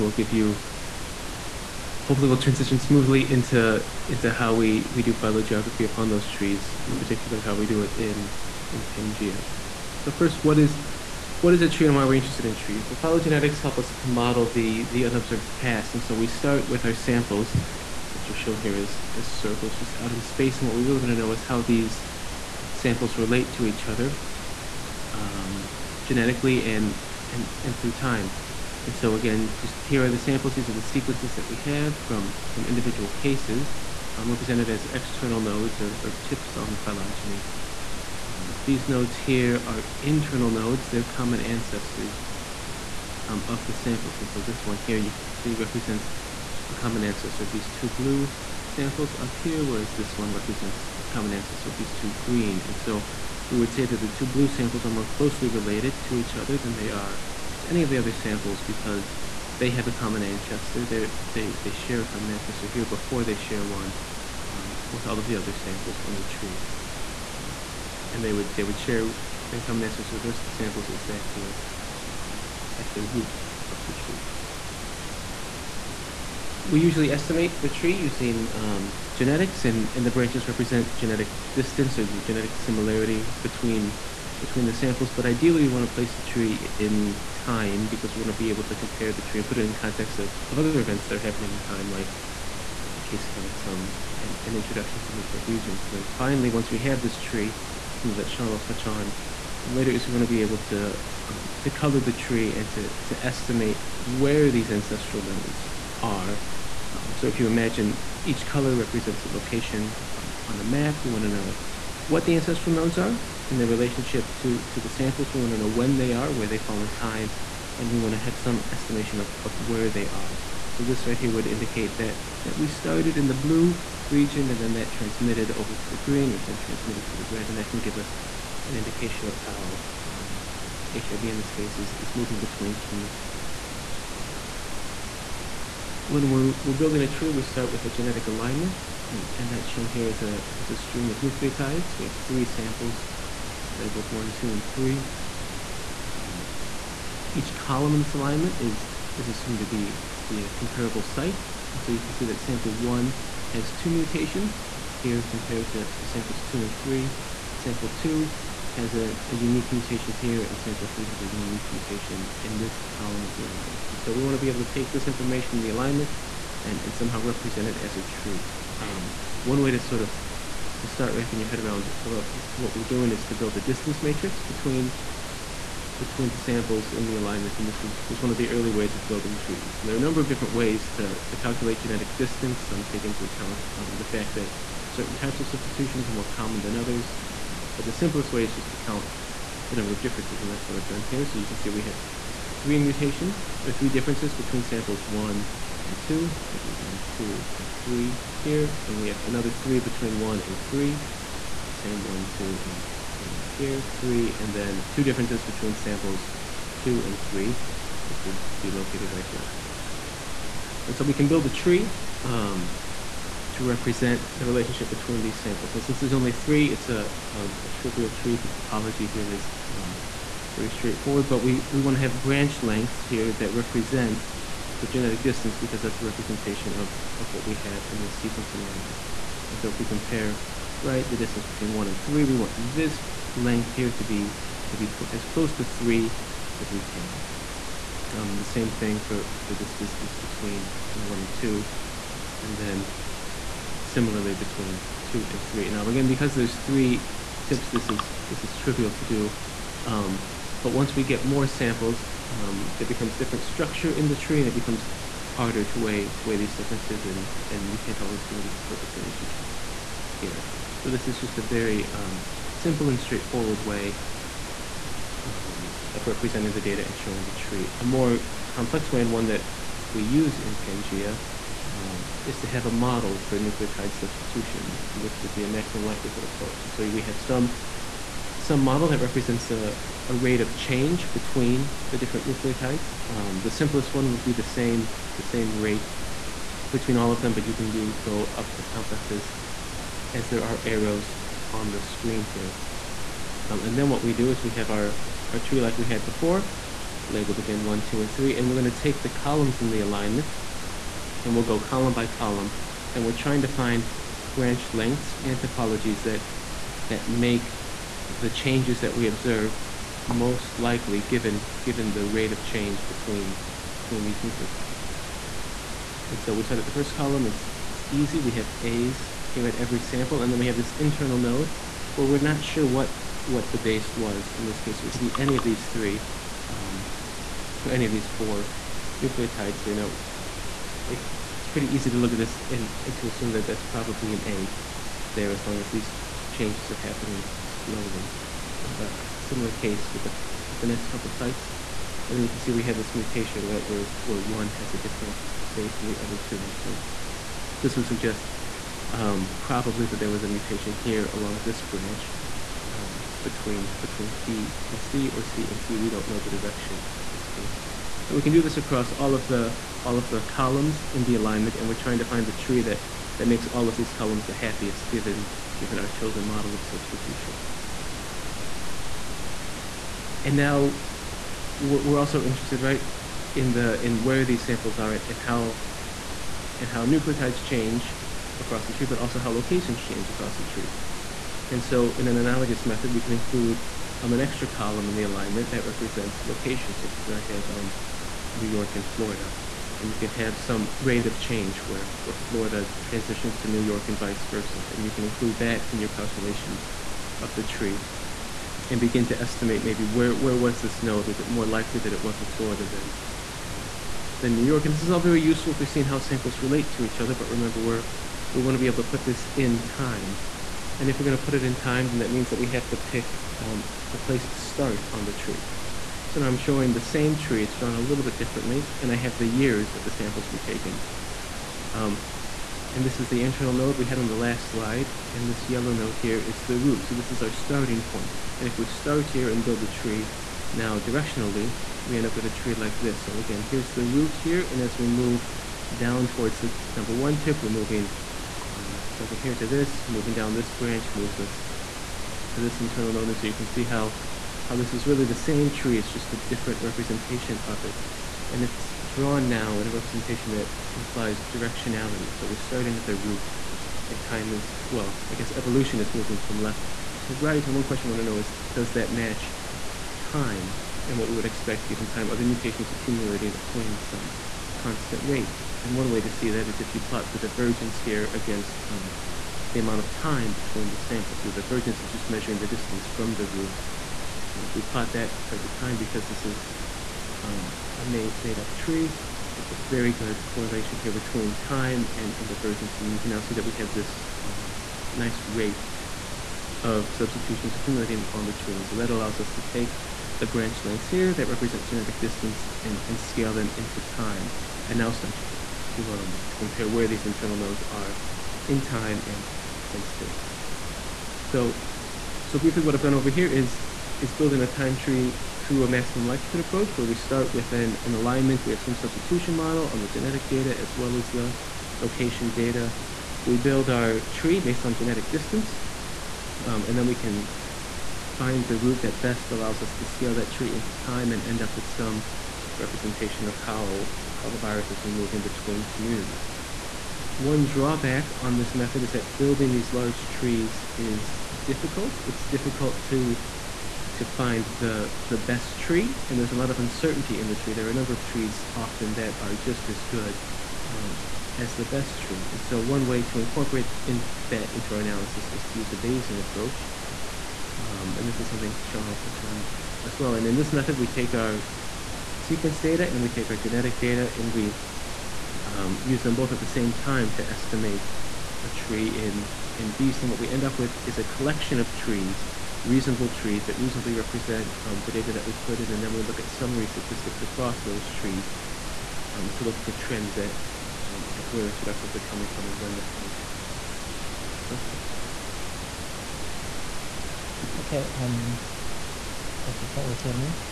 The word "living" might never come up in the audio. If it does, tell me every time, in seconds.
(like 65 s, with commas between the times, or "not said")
not said.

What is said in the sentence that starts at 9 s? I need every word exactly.
So first, what is, what is a tree and why we're interested in trees?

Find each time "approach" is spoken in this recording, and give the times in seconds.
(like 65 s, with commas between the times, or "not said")
276 s, 506 s, 546 s.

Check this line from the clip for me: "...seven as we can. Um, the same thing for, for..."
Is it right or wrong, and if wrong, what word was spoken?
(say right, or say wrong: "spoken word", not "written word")
wrong: "three", not "seven".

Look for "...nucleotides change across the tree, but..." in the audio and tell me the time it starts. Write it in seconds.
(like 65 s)
376 s.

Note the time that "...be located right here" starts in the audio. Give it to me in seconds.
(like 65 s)
208 s.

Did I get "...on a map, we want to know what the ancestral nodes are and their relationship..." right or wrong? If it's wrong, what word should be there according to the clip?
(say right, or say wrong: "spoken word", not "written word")
right.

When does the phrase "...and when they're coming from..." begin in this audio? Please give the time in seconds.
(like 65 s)
572 s.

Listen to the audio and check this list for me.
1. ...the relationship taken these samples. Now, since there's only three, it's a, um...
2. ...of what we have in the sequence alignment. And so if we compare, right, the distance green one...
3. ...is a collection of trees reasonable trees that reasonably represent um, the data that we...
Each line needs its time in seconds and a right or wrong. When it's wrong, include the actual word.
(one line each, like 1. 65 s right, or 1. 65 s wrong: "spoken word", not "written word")
1. 214 s wrong: "between", not "taken"
2. 227 s wrong: "between", not "green"
3. 560 s right.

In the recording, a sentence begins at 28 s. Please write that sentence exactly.
And so again, just here are the samples.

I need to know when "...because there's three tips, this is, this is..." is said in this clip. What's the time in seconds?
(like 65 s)
246 s.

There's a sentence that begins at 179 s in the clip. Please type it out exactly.
And there are a number of different ways to, to calculate genetic distance.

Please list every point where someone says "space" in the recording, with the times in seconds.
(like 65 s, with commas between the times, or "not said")
20 s, 499 s.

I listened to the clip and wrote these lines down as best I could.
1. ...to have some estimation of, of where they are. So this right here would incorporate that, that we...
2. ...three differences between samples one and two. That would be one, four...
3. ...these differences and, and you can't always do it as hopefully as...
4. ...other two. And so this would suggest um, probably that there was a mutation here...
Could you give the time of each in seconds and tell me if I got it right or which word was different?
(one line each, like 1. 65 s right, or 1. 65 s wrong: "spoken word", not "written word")
1. 118 s wrong: "indicate", not "incorporate"
2. 193 s wrong: "two", not "four"
3. 256 s wrong: "perfectly", not "hopefully"
4. 346 s right.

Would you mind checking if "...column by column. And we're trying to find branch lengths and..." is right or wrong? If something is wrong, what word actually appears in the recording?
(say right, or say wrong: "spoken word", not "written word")
right.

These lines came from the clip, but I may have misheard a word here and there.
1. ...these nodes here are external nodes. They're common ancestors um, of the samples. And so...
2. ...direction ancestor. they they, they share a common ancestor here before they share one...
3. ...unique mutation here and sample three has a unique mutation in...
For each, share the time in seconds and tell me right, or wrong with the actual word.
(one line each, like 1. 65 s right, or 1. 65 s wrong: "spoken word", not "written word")
1. 38 s wrong: "internal", not "external"
2. 59 s wrong: "common", not "direction"
3. 159 s right.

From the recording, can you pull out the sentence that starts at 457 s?
And one question I wanna know is, does that match time and what we would expect given time?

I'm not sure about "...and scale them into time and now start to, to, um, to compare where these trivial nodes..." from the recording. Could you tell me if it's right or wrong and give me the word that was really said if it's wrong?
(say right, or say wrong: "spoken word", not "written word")
wrong: "internal", not "trivial".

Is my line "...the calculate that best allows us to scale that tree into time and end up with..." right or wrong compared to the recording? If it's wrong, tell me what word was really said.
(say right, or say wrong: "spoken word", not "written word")
wrong: "route", not "calculate".